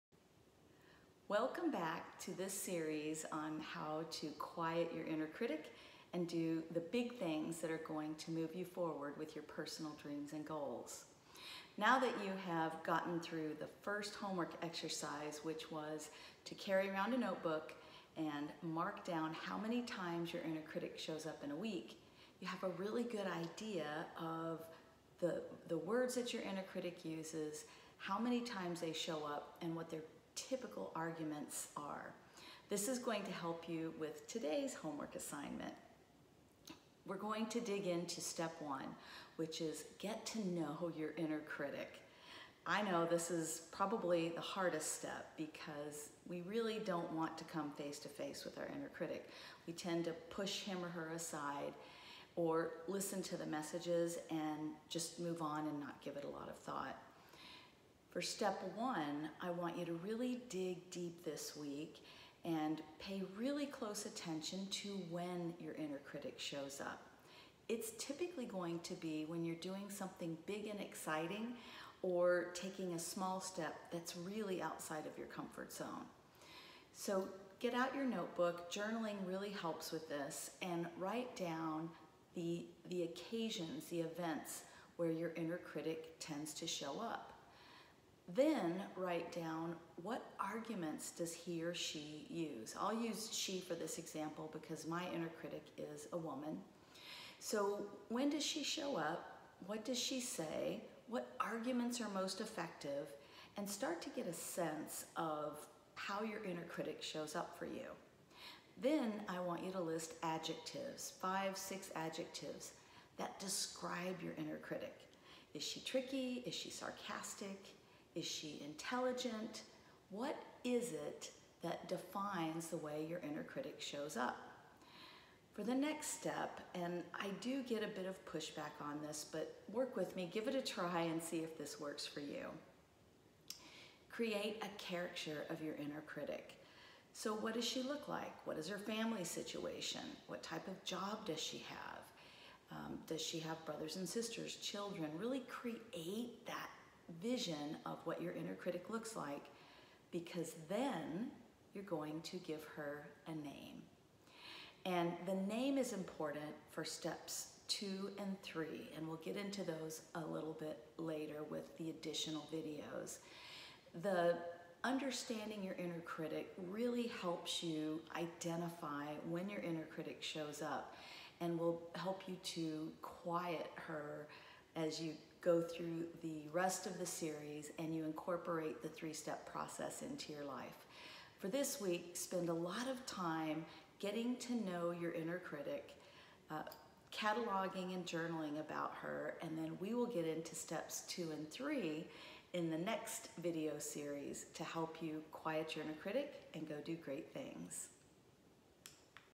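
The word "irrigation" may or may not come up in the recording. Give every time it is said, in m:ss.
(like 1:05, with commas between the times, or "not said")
not said.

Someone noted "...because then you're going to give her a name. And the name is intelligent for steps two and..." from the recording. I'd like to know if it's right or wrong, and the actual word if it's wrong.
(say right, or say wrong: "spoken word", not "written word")
wrong: "important", not "intelligent".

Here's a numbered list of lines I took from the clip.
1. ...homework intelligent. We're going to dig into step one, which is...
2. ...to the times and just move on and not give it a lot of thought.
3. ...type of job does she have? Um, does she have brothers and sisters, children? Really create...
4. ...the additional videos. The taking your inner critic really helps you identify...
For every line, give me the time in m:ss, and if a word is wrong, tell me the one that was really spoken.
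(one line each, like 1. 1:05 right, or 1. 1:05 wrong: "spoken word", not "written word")
1. 0:34 wrong: "assignment", not "intelligent"
2. 0:53 wrong: "messages", not "times"
3. 2:20 right
4. 2:41 wrong: "understanding", not "taking".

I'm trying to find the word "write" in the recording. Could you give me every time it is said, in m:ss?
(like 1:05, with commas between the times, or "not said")
1:20, 1:28.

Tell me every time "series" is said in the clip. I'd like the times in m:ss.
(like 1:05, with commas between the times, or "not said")
0:02, 2:57, 3:13.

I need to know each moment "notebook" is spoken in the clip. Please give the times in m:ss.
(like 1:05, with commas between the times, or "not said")
0:17, 1:18.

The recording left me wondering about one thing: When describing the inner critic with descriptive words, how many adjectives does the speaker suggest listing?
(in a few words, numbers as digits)
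5 or 6.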